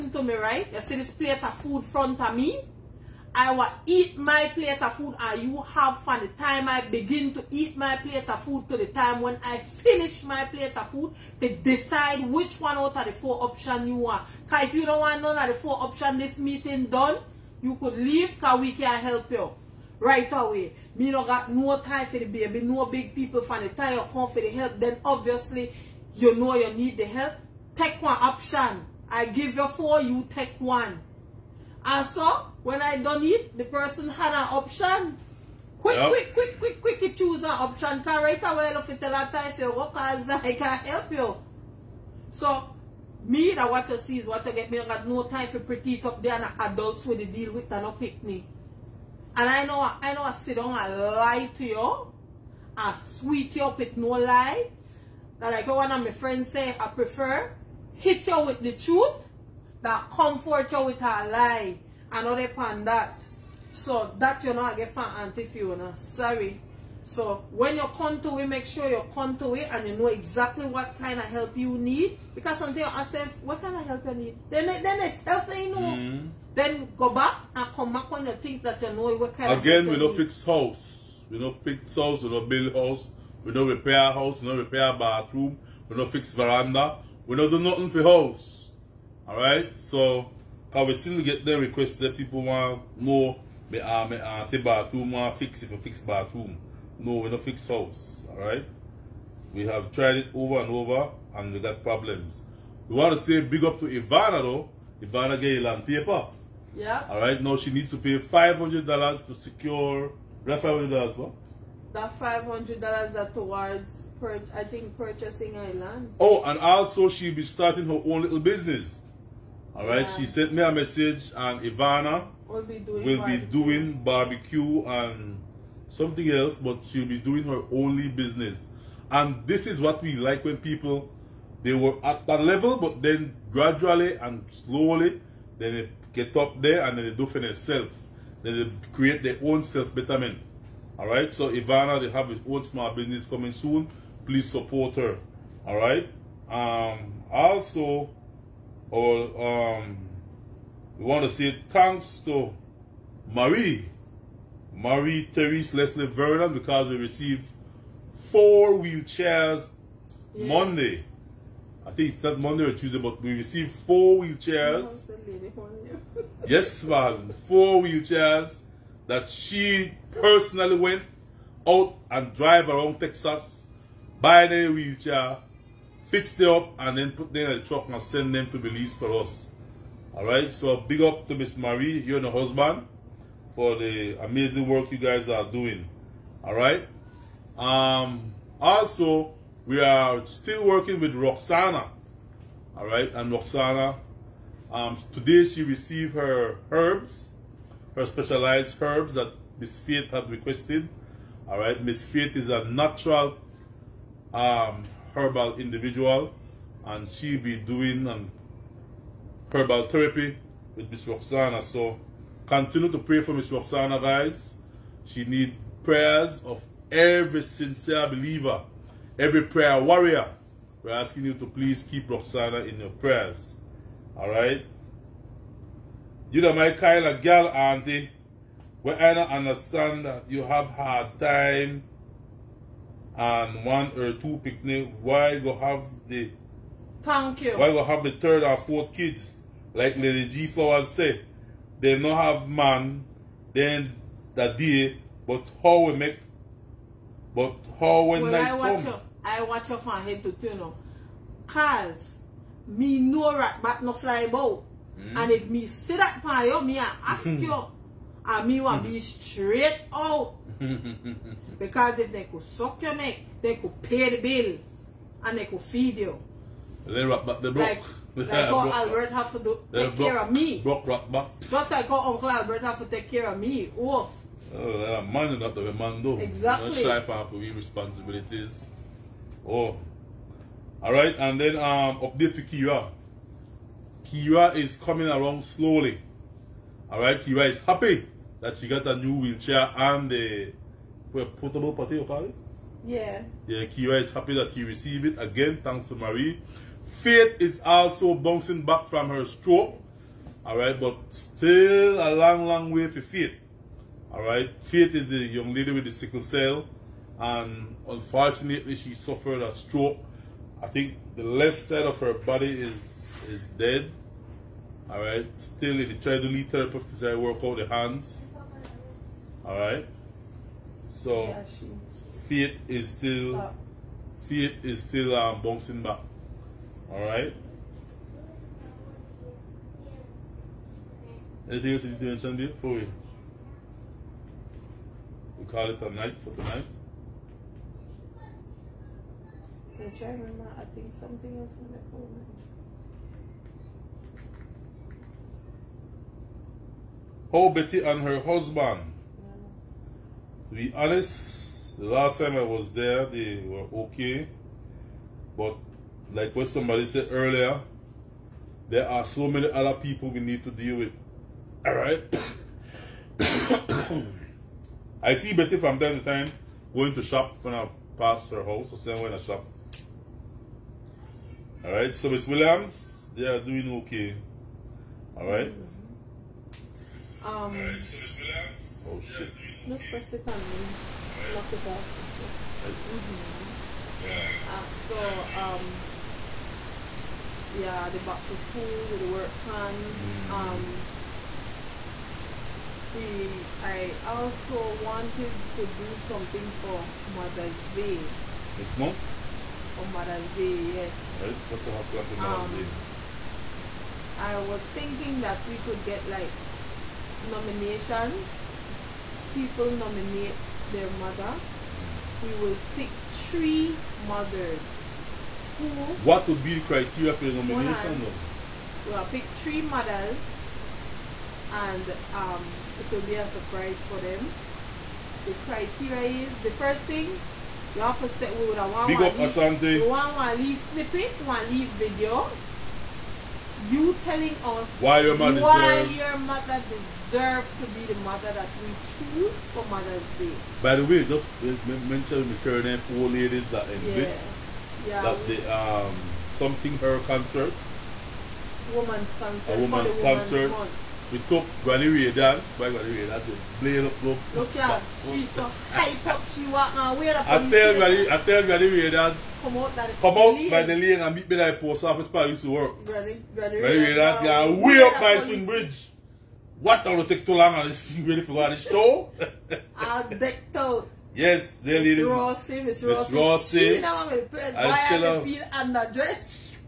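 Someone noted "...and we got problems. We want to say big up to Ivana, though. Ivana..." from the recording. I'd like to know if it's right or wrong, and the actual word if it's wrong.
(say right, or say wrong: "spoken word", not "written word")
right.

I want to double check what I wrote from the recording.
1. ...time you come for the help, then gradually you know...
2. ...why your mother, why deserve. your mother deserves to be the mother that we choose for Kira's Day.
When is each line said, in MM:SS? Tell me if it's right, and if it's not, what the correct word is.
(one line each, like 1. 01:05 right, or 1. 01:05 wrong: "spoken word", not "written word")
1. 00:23 wrong: "obviously", not "gradually"
2. 07:14 wrong: "Mother", not "Kira".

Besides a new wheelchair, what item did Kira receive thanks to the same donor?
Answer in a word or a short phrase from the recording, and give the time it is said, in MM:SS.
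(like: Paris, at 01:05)
Portable potty, at 04:51.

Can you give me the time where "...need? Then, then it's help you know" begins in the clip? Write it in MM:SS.
01:14.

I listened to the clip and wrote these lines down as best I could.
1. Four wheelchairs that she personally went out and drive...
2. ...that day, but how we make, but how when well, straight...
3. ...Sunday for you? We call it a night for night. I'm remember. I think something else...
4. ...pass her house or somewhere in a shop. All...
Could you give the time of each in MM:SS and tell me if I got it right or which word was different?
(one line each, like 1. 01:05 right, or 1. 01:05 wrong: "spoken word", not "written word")
1. 02:47 right
2. 04:04 wrong: "night", not "straight"
3. 05:32 wrong: "tonight", not "night"
4. 06:07 right.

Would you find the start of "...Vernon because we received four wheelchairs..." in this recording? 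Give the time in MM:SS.
02:36.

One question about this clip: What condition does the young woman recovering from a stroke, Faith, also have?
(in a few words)
Sickle cell.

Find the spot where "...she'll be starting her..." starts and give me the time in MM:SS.
01:57.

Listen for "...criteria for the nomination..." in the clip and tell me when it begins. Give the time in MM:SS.
06:56.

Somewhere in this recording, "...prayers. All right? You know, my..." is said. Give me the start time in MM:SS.
03:42.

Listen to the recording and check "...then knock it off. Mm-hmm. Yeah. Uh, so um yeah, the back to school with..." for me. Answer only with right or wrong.
right.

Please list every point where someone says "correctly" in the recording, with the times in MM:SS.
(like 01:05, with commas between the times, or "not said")
not said.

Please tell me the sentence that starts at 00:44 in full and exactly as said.
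Me don't got no time for pretty it up there and adults when they deal with and no me.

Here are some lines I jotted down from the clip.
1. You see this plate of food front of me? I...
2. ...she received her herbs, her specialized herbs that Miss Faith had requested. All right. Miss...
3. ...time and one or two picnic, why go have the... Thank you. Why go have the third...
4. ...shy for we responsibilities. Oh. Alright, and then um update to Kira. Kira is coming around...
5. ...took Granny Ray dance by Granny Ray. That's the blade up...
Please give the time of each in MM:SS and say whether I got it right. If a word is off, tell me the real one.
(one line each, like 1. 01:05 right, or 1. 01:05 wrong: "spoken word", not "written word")
1. 00:00 right
2. 03:15 right
3. 03:51 right
4. 04:36 right
5. 07:31 right.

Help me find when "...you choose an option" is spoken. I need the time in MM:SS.
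00:37.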